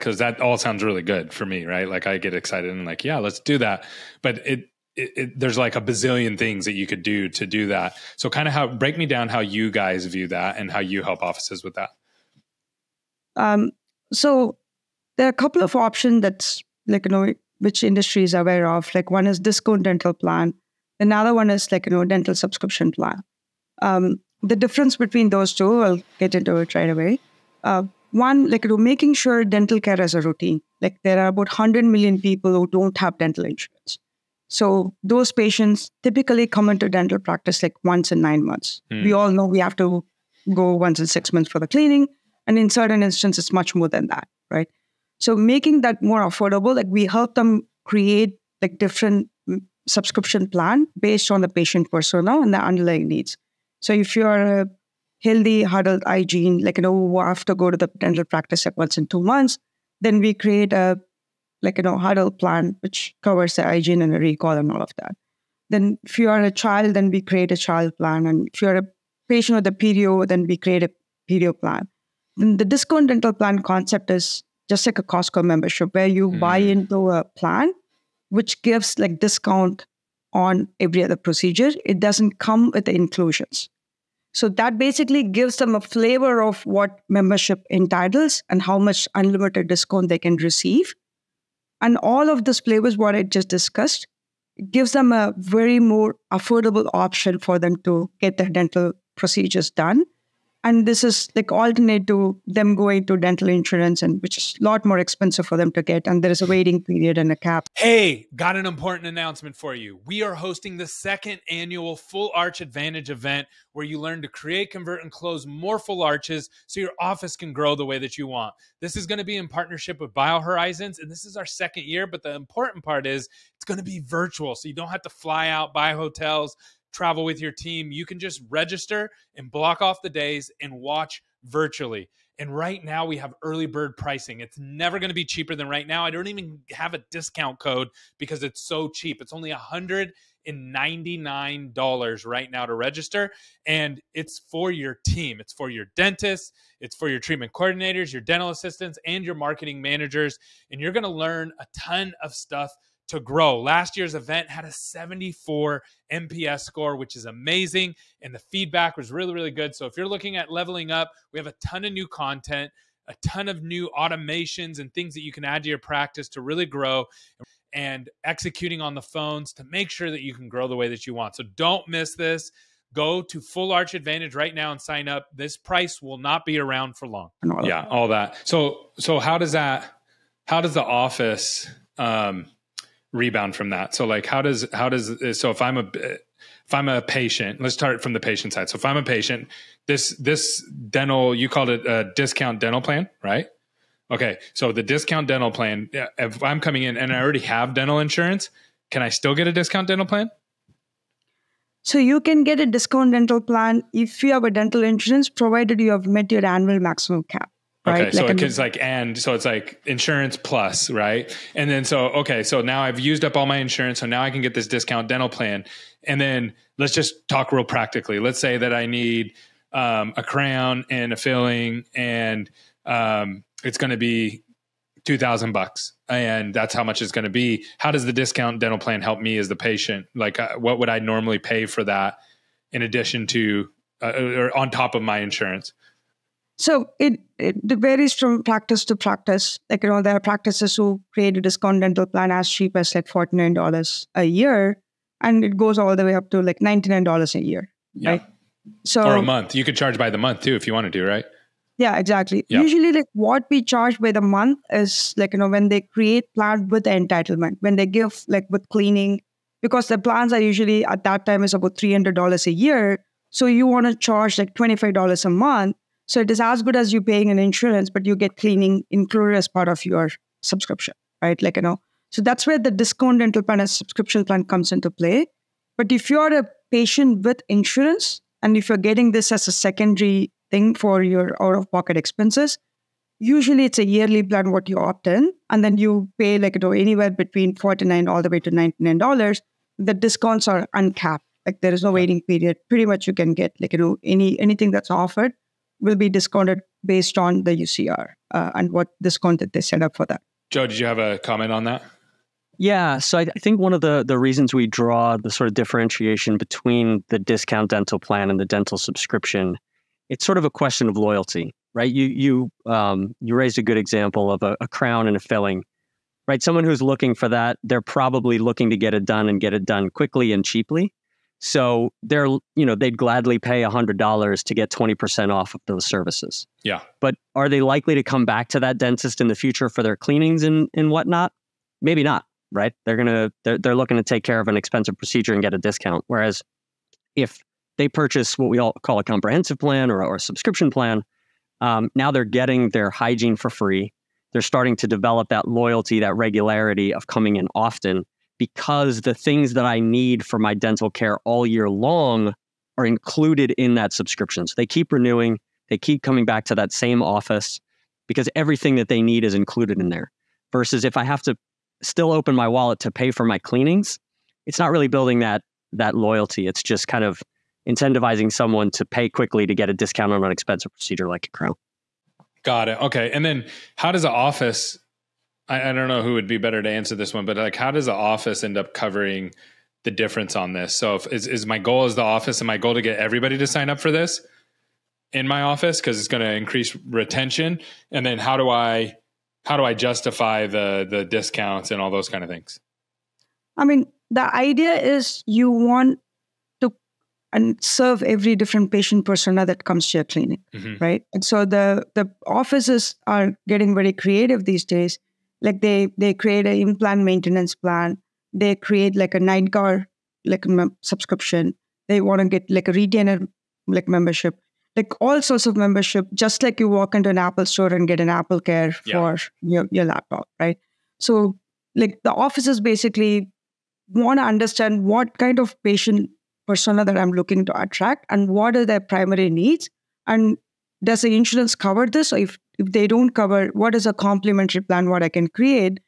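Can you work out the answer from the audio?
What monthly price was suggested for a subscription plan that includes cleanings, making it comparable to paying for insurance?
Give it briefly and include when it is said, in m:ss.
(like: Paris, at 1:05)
$25, at 4:24.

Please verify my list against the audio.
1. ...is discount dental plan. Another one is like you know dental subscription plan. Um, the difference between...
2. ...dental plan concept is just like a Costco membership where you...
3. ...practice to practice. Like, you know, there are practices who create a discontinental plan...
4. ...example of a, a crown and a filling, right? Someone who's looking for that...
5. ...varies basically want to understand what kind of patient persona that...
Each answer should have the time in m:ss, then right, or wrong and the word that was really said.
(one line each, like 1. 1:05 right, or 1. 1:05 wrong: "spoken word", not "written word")
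1. 0:19 right
2. 1:13 right
3. 3:58 right
4. 5:13 right
5. 7:02 wrong: "offices", not "varies".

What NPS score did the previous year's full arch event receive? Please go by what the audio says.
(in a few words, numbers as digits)
74.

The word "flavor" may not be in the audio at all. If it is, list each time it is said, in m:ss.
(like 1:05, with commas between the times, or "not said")
1:25, 1:32.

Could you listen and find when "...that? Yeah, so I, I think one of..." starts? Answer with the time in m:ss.
5:01.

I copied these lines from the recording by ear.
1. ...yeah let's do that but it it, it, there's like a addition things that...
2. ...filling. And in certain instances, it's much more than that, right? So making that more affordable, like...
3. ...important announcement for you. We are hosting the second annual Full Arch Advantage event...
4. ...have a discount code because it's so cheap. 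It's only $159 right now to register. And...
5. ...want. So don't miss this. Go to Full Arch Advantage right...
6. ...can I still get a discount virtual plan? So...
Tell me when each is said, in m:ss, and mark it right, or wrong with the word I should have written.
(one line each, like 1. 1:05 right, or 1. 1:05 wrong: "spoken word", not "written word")
1. 0:03 wrong: "bazillion", not "addition"
2. 0:41 wrong: "cleaning", not "filling"
3. 1:48 right
4. 2:16 wrong: "199", not "159"
5. 2:51 right
6. 3:18 wrong: "dental", not "virtual".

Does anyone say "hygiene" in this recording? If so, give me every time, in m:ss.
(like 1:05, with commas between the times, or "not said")
0:56, 1:03, 5:42.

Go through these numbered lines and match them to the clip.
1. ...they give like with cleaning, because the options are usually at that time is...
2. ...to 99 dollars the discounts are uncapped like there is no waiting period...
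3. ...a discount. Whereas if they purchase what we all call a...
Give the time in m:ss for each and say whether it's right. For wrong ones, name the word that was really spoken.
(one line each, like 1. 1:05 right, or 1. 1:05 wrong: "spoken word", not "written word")
1. 4:17 wrong: "plans", not "options"
2. 4:48 right
3. 5:35 right.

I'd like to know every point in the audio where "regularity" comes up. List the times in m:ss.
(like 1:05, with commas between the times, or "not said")
5:46.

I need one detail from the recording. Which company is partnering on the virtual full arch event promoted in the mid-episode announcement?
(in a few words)
BioHorizons.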